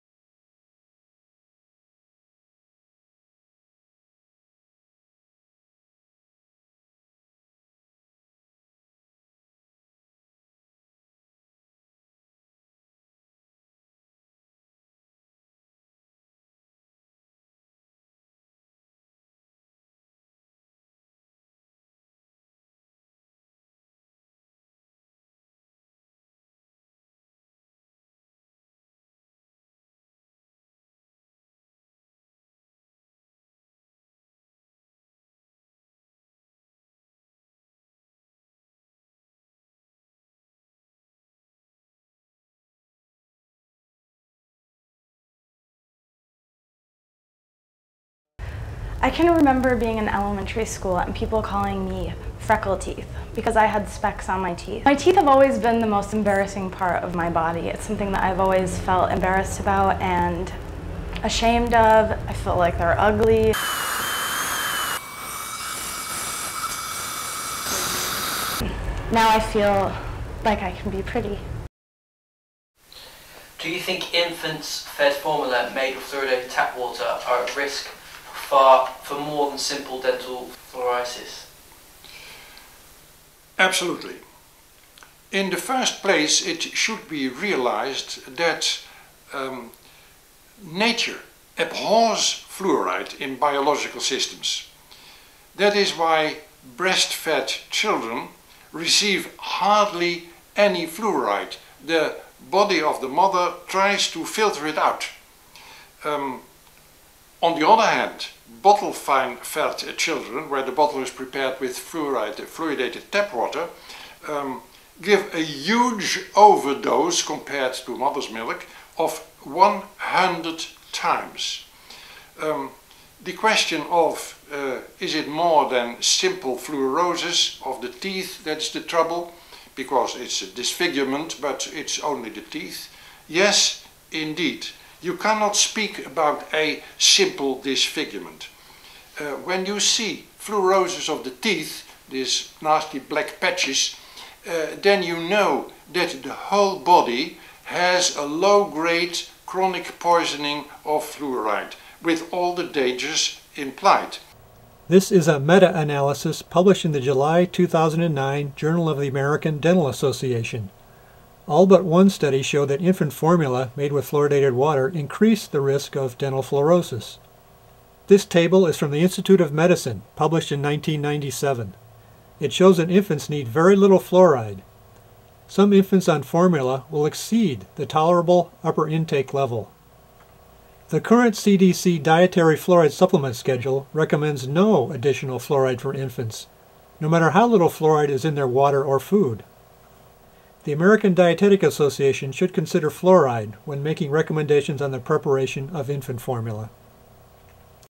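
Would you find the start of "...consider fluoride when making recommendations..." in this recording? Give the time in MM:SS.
03:12.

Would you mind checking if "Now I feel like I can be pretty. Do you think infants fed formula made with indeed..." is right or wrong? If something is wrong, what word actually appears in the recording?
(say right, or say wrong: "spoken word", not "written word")
wrong: "fluoridated", not "indeed".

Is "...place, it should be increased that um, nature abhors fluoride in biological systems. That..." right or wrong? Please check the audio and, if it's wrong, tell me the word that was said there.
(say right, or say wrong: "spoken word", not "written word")
wrong: "realized", not "increased".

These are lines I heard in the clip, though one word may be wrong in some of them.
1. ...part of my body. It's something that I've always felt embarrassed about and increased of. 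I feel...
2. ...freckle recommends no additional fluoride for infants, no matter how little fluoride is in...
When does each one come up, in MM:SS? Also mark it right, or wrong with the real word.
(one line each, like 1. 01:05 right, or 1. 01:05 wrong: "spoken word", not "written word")
1. 00:56 wrong: "ashamed", not "increased"
2. 03:03 wrong: "schedule", not "freckle".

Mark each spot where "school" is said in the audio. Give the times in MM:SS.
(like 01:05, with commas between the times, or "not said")
00:50.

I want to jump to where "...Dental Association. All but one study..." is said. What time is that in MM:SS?
02:39.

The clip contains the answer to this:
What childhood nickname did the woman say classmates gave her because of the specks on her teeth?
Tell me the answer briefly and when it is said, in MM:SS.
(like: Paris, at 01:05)
freckle teeth, at 00:52.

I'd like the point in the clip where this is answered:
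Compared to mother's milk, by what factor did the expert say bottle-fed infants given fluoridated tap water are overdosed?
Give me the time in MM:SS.
01:59.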